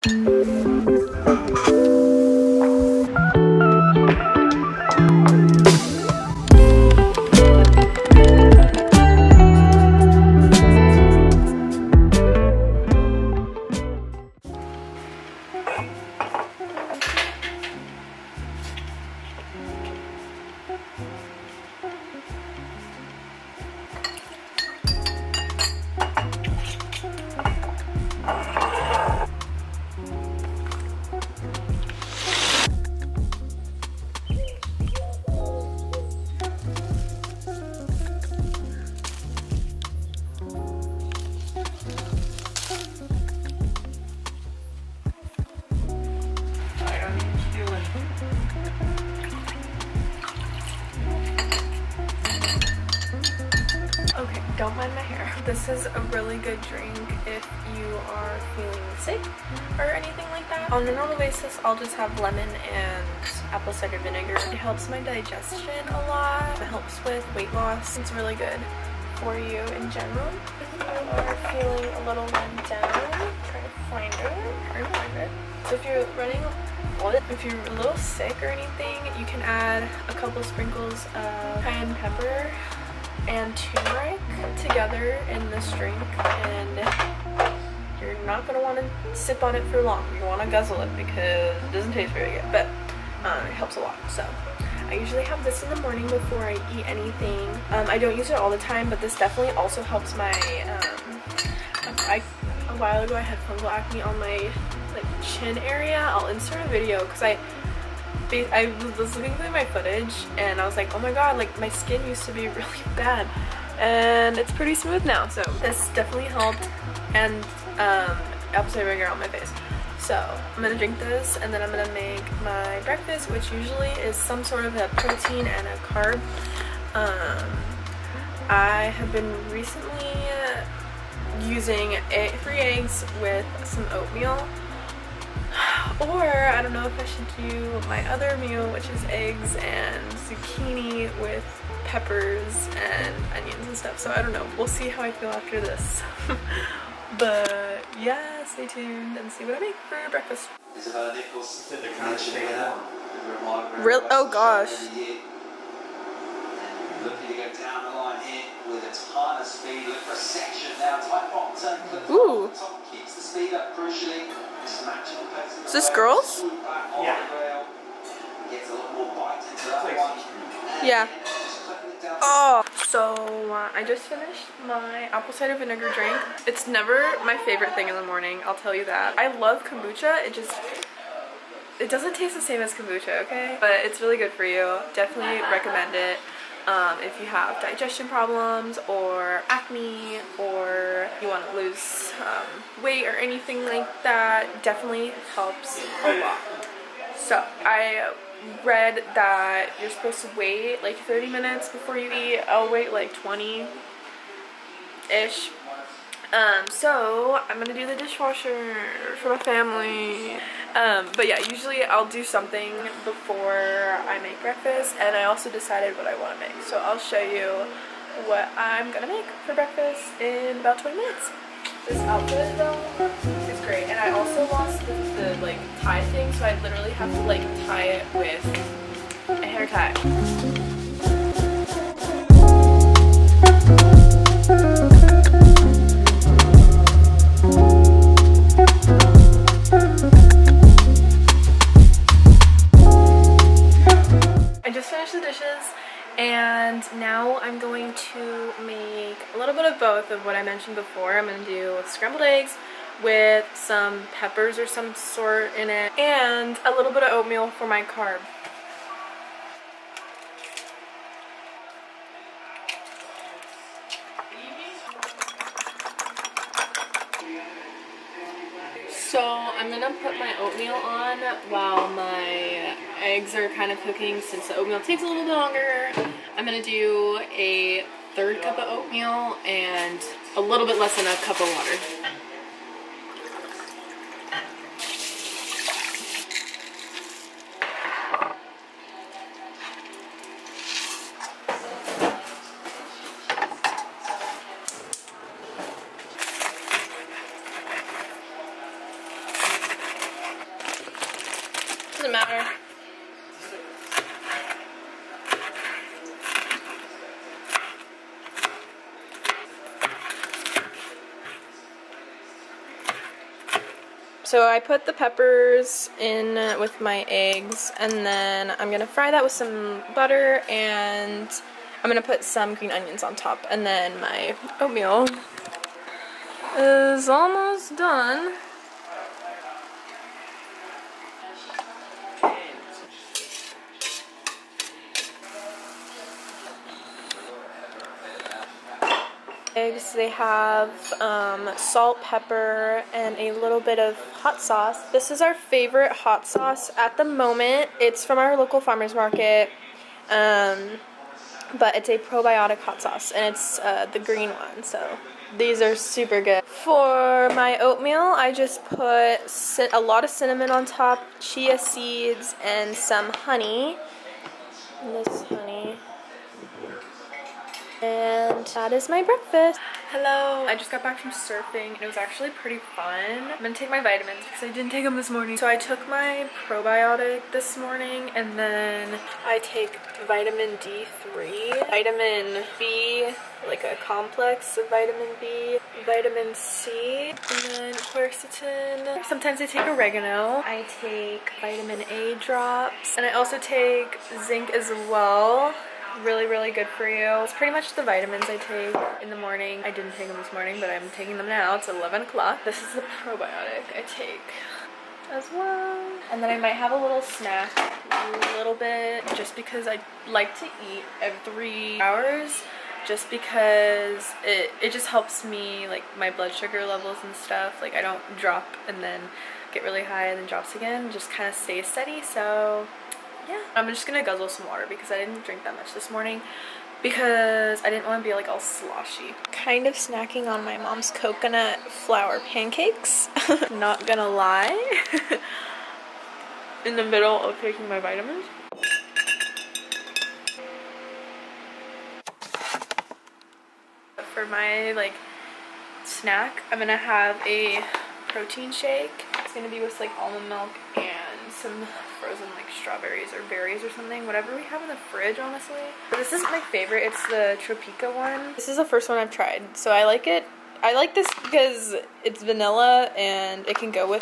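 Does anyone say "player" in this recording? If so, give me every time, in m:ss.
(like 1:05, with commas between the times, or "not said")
not said.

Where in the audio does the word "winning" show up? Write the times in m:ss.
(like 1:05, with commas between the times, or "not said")
not said.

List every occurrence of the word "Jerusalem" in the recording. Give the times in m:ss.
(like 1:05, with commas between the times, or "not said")
not said.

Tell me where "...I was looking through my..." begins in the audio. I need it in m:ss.
1:48.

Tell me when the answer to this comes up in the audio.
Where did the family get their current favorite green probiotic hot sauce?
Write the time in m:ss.
5:48.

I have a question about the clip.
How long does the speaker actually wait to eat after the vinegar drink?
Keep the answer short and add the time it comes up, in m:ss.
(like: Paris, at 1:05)
20 minutes, at 3:23.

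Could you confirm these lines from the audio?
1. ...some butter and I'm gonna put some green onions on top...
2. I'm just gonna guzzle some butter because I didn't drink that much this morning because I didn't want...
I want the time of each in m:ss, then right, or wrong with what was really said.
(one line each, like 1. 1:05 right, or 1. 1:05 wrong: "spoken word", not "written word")
1. 5:19 right
2. 7:03 wrong: "water", not "butter".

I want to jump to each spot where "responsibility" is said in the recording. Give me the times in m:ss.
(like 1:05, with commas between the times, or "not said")
not said.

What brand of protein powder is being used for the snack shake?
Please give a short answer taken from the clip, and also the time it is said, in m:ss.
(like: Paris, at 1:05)
Tropeaka, at 7:37.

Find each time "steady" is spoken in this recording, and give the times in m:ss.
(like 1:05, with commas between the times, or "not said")
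7:01.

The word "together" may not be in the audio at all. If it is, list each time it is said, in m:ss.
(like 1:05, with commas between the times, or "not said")
1:24.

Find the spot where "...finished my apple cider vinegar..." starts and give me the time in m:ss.
2:54.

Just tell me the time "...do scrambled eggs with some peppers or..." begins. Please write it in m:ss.
4:11.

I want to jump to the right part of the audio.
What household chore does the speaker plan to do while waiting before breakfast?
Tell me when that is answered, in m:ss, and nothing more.
3:27.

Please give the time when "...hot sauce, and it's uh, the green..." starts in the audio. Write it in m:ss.
5:52.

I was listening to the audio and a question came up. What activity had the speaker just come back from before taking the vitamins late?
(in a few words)
surfing.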